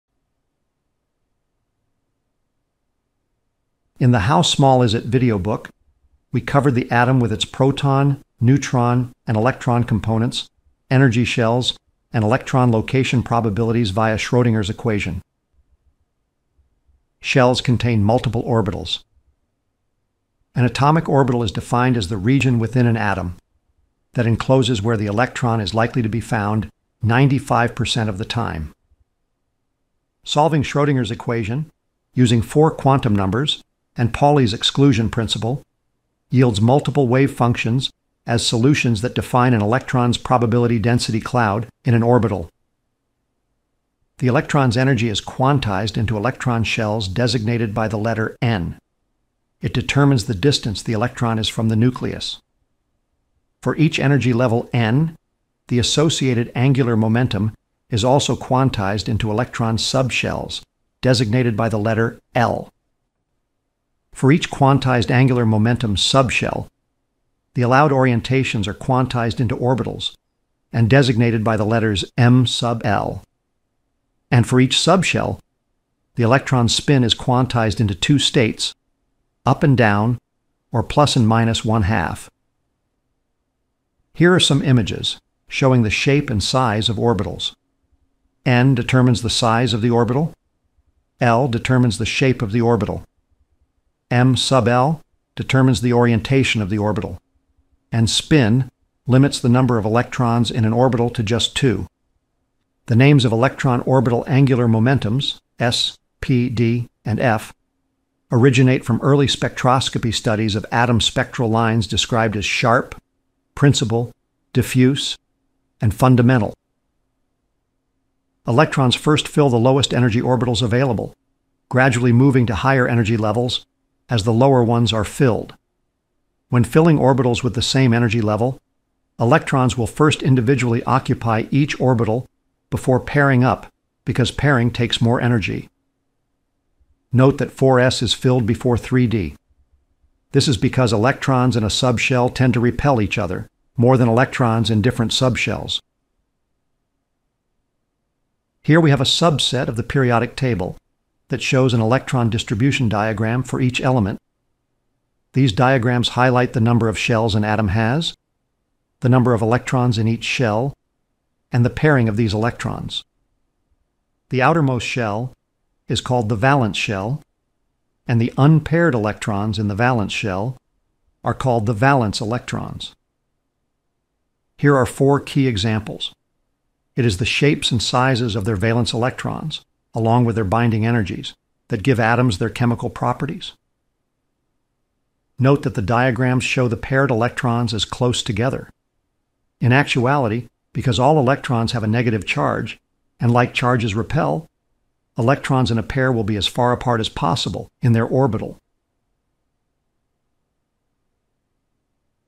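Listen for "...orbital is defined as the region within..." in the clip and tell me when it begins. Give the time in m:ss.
0:21.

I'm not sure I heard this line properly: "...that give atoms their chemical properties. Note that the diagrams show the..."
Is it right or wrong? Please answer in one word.
right.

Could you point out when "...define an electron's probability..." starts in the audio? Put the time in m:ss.
0:39.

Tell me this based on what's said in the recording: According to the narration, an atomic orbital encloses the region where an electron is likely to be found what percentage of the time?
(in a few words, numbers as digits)
95%.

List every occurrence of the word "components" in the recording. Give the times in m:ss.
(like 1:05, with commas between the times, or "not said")
0:09.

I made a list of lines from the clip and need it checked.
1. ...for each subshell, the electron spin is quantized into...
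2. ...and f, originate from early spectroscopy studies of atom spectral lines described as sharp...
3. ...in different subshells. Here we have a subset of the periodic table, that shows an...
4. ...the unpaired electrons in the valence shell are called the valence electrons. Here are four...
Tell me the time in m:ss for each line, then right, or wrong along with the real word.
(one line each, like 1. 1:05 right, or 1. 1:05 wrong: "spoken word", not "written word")
1. 1:14 right
2. 1:47 right
3. 2:24 right
4. 2:48 right.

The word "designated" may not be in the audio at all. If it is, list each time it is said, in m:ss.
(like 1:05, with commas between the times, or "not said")
0:47, 1:01, 1:10.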